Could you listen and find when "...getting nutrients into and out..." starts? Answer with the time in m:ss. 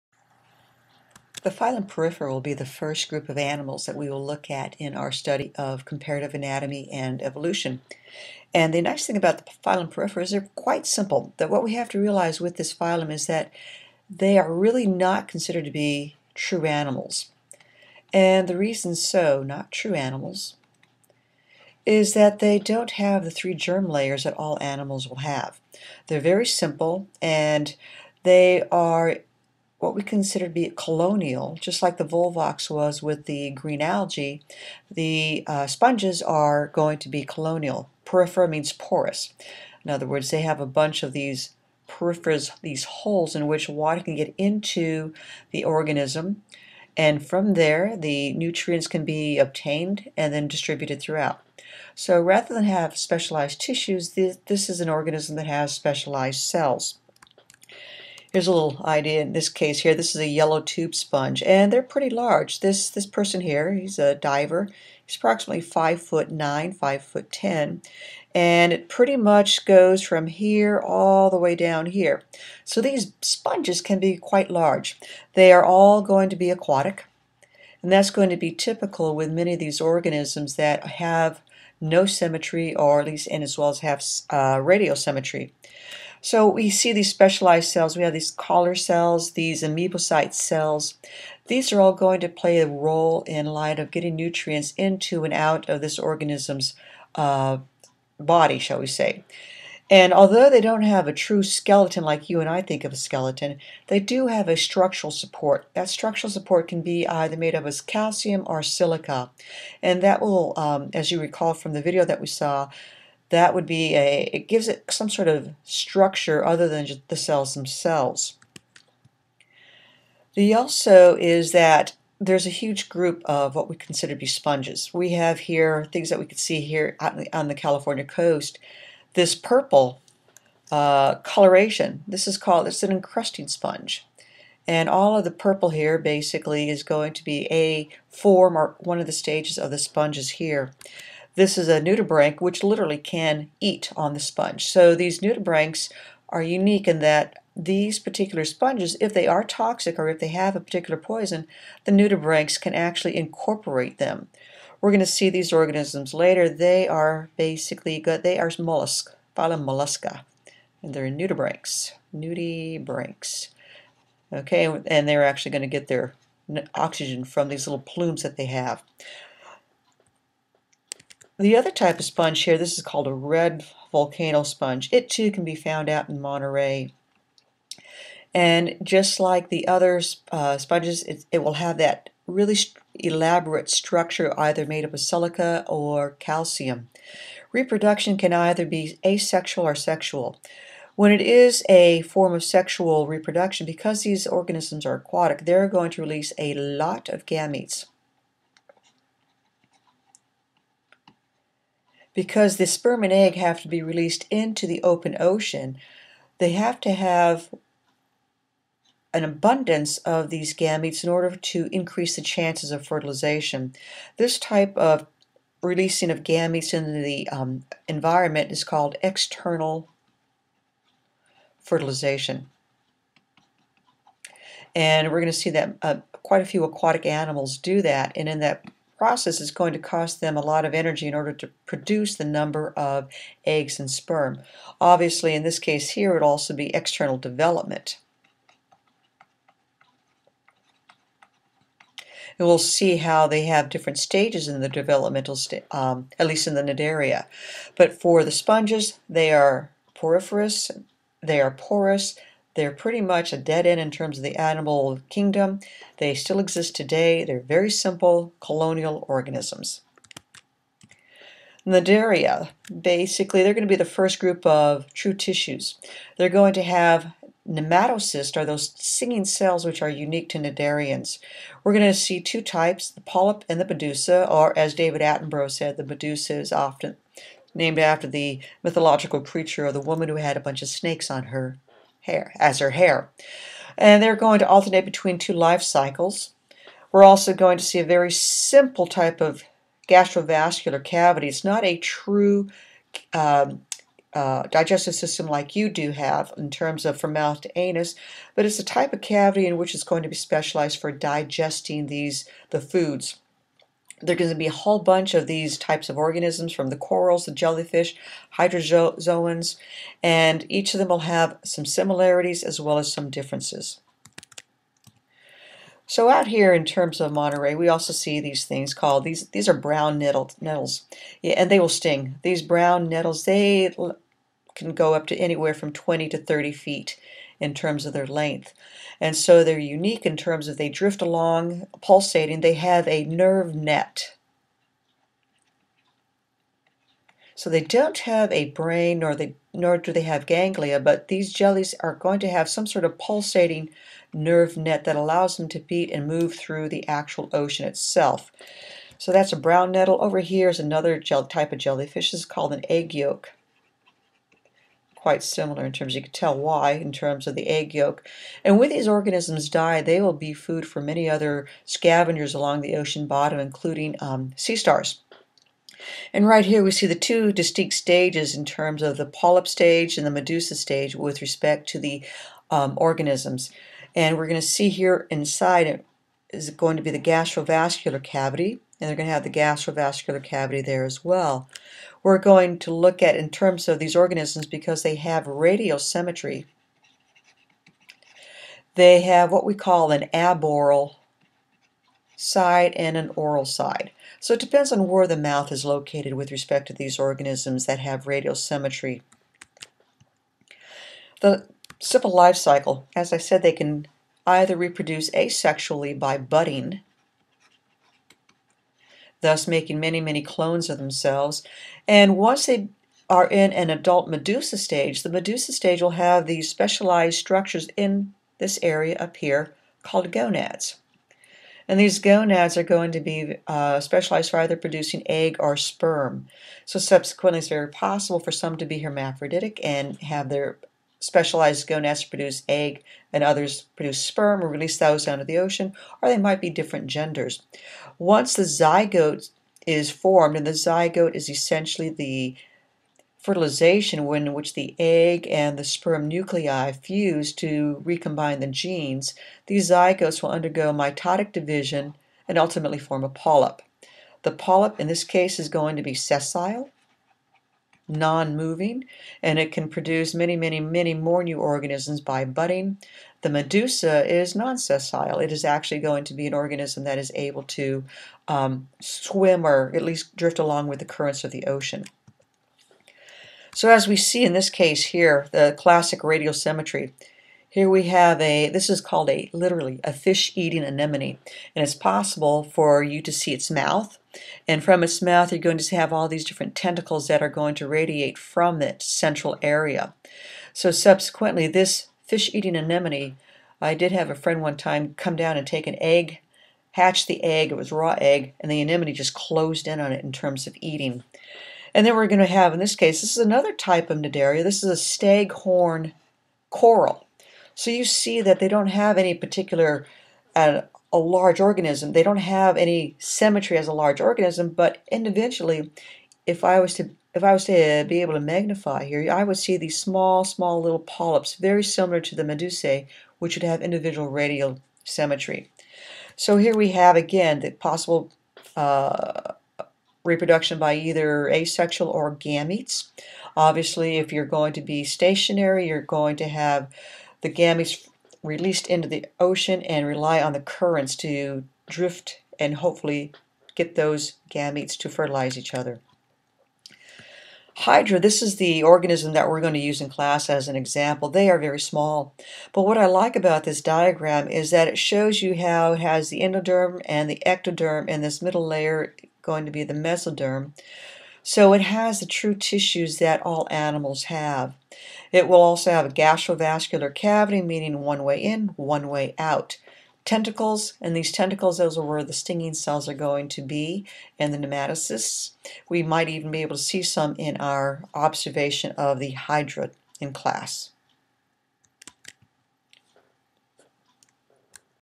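1:33.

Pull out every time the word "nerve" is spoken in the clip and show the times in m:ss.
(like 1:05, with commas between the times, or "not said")
5:33, 5:44.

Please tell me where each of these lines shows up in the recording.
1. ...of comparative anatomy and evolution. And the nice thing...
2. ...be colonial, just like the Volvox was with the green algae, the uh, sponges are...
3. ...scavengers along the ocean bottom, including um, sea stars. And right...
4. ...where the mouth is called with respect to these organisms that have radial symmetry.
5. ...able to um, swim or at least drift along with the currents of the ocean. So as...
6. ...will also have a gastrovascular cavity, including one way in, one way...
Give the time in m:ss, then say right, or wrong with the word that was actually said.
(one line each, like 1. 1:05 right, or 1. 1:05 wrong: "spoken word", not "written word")
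1. 0:05 right
2. 0:30 right
3. 6:01 right
4. 6:34 wrong: "located", not "called"
5. 7:47 right
6. 9:25 wrong: "meaning", not "including".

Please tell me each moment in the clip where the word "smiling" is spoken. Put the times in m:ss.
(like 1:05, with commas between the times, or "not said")
not said.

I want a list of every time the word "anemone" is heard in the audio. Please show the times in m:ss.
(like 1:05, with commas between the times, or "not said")
8:00, 8:12, 8:18.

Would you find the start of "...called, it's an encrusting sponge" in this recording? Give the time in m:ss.
2:12.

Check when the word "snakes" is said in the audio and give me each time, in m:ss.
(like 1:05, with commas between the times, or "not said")
4:40.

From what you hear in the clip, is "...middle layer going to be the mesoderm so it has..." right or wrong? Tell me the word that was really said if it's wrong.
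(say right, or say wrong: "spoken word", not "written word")
right.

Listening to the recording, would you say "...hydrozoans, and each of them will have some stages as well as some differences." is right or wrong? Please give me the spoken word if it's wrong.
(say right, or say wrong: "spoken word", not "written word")
wrong: "similarities", not "stages".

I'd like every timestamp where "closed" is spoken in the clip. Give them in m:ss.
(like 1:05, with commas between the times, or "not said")
8:19.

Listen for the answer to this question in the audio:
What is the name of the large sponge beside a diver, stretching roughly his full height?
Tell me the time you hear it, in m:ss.
1:00.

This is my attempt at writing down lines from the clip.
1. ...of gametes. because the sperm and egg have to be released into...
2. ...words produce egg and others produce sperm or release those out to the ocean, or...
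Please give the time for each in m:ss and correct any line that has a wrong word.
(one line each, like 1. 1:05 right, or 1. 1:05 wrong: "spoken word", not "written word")
1. 3:17 right
2. 7:11 wrong: "gonads", not "words".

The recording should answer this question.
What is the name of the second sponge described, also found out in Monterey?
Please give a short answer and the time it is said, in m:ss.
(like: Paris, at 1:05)
Red volcano sponge, at 2:53.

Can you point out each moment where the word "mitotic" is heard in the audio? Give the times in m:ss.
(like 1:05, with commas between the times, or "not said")
7:30.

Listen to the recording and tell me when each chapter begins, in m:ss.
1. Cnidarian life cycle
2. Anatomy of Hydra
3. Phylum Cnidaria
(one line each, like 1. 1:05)
1. 6:39
2. 9:05
3. 5:14.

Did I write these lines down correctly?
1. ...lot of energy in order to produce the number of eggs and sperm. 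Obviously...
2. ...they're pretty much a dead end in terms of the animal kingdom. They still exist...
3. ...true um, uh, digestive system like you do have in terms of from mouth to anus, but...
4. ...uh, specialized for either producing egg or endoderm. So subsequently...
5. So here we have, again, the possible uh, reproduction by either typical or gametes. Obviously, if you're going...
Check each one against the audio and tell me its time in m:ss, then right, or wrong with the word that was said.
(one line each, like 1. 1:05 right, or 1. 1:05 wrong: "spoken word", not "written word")
1. 3:50 right
2. 4:12 right
3. 4:51 right
4. 7:03 wrong: "sperm", not "endoderm"
5. 8:46 wrong: "asexual", not "typical".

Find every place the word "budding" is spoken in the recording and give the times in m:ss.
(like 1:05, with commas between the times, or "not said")
6:46, 7:42.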